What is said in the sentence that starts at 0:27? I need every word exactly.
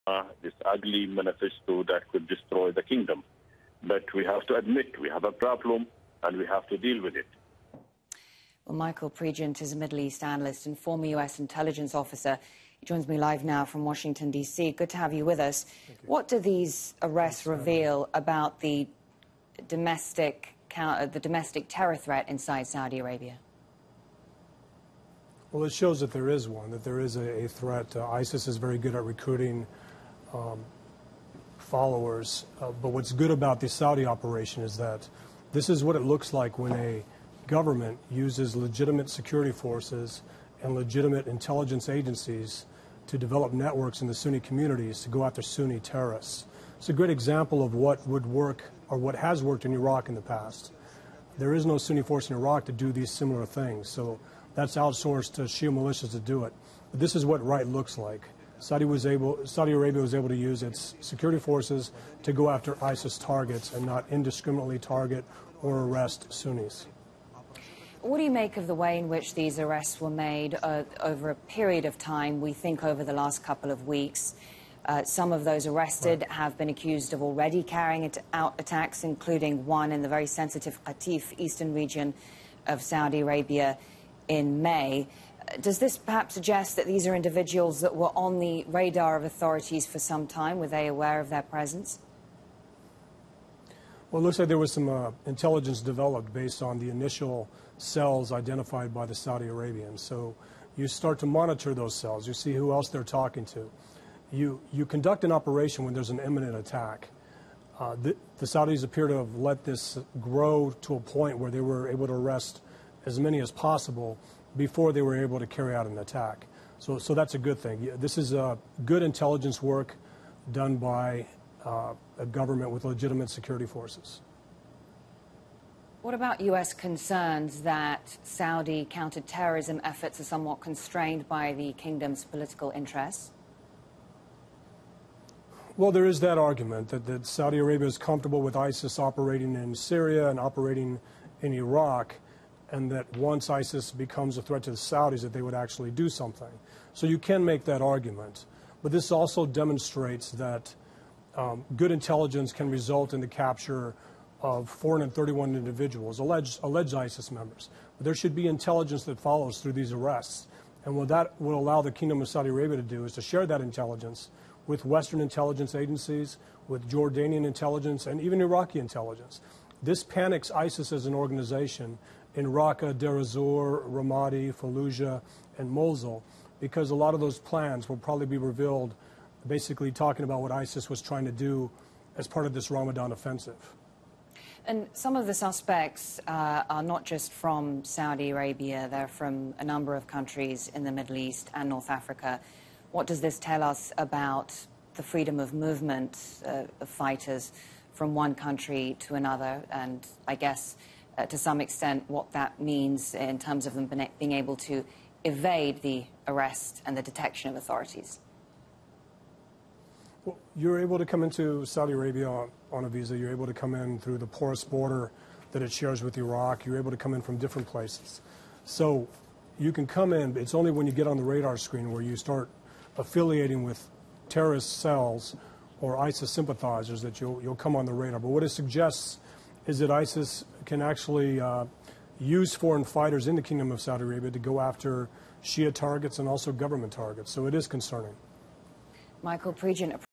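Uh, ISIS is very good at recruiting um, followers.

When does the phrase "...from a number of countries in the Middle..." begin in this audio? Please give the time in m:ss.
3:09.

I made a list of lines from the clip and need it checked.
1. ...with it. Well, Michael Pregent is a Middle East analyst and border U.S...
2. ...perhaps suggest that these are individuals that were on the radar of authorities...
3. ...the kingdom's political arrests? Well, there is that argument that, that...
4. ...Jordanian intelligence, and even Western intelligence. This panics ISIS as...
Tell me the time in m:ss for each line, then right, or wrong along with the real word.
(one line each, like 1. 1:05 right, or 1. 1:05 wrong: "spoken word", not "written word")
1. 0:07 wrong: "former", not "border"
2. 1:25 right
3. 2:11 wrong: "interests", not "arrests"
4. 2:46 wrong: "Iraqi", not "Western".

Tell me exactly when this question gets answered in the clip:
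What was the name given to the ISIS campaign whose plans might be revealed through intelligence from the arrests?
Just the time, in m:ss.
3:02.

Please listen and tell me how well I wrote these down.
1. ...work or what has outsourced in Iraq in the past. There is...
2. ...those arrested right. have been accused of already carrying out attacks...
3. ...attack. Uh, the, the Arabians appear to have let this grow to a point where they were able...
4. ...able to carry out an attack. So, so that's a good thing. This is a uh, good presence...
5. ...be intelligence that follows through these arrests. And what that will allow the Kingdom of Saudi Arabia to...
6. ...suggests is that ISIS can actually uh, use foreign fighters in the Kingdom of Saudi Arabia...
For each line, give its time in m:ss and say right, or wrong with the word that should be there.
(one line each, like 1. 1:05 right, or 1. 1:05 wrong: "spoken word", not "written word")
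1. 0:48 wrong: "worked", not "outsourced"
2. 1:15 right
3. 1:46 wrong: "Saudis", not "Arabians"
4. 1:55 wrong: "intelligence", not "presence"
5. 2:38 right
6. 3:48 right.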